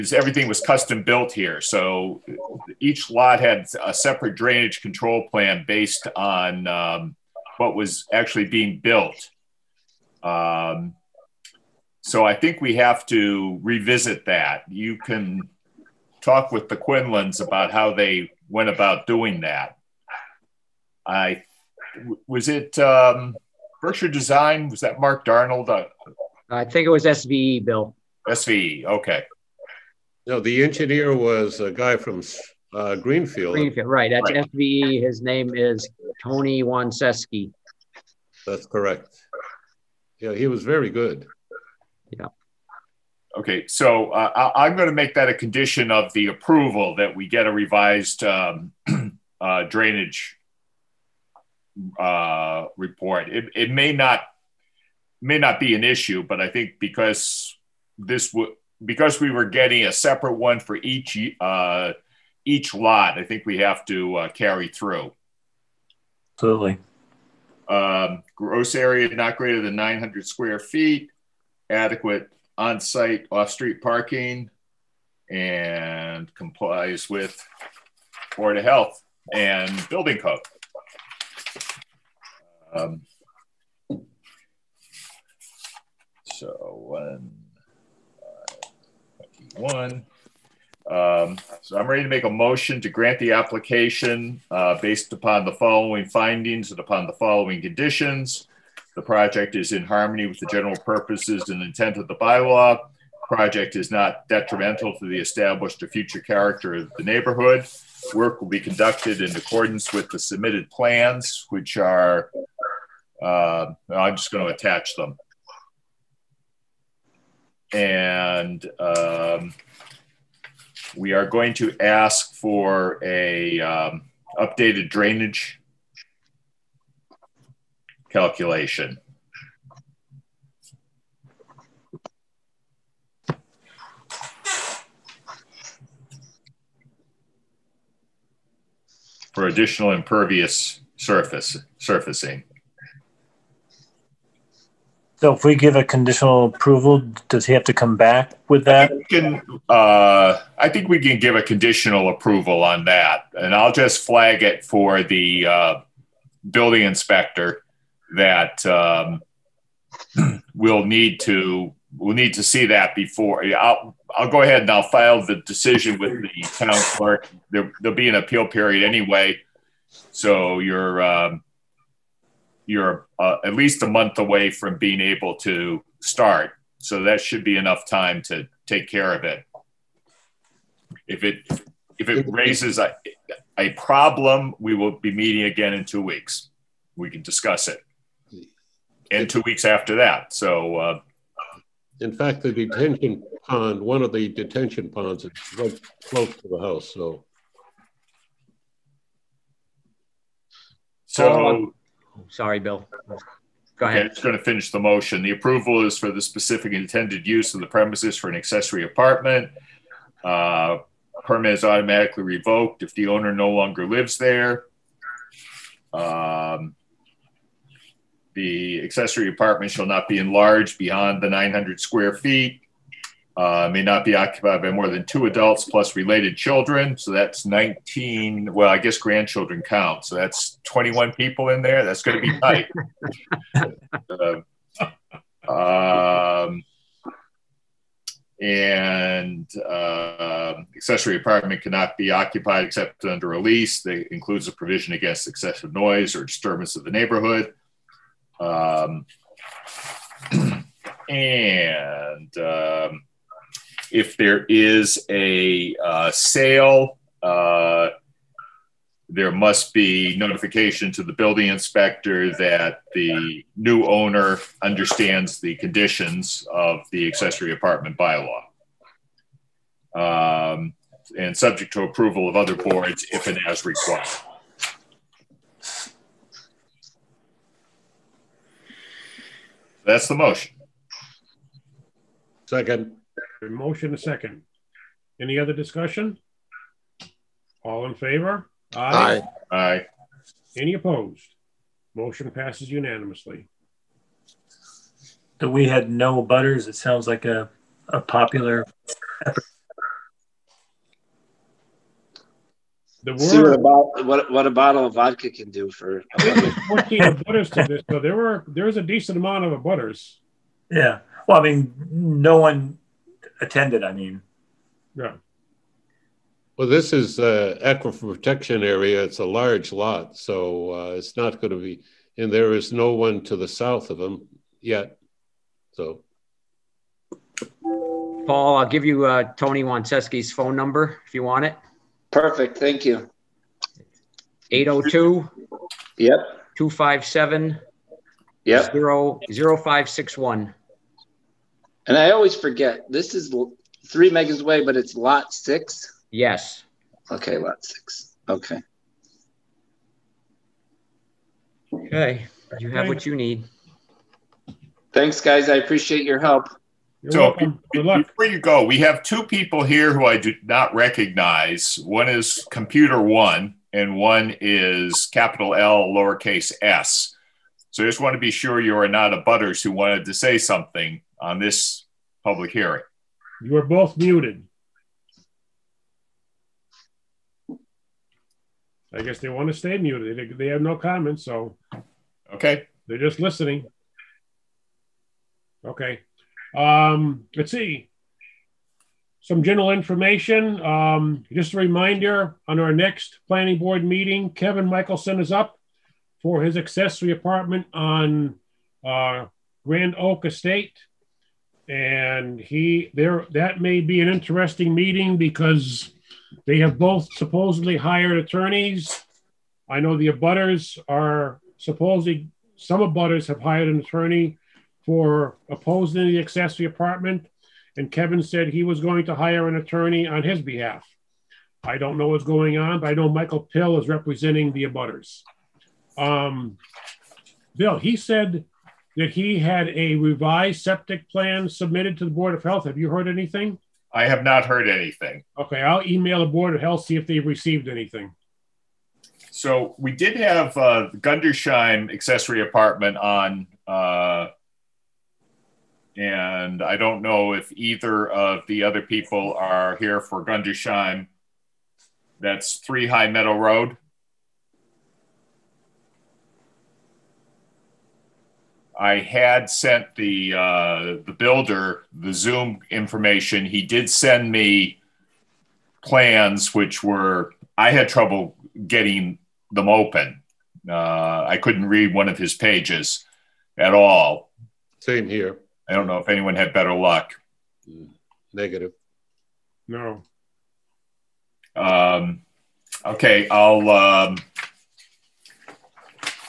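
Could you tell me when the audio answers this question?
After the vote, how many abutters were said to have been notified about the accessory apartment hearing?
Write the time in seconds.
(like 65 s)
306 s.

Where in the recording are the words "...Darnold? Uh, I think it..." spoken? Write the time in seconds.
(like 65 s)
25 s.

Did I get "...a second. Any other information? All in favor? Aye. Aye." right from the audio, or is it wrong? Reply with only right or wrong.
wrong.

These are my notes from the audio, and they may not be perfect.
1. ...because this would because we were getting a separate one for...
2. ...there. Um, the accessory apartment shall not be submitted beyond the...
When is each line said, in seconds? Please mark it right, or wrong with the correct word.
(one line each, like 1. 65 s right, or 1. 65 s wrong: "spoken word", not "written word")
1. 56 s right
2. 214 s wrong: "enlarged", not "submitted".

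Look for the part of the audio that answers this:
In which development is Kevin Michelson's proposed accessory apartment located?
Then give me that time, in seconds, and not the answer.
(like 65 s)
399 s.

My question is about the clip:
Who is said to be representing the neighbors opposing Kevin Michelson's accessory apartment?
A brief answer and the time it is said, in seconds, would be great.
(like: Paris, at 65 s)
Michael Pill, at 423 s.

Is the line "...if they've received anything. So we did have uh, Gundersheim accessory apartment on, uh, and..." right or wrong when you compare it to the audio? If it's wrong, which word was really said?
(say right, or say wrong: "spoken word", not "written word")
right.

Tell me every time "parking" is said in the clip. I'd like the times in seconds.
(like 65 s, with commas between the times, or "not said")
73 s.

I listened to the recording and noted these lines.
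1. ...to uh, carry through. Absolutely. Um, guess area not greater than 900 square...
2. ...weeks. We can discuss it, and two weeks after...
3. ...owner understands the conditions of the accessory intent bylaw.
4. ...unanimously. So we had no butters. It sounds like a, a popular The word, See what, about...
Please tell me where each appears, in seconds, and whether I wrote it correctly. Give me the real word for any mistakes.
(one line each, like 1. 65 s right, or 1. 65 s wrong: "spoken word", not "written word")
1. 63 s wrong: "gross", not "guess"
2. 186 s right
3. 263 s wrong: "apartment", not "intent"
4. 292 s right.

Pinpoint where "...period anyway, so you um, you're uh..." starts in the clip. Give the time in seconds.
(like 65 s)
168 s.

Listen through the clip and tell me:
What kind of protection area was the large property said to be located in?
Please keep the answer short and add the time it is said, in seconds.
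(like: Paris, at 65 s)
aquifer protection area, at 317 s.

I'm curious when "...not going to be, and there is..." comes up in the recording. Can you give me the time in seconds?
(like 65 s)
321 s.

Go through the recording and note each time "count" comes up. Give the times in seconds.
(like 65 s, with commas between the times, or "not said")
229 s.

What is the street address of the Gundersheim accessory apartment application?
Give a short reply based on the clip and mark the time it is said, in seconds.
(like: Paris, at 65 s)
3 High Meadow Road, at 452 s.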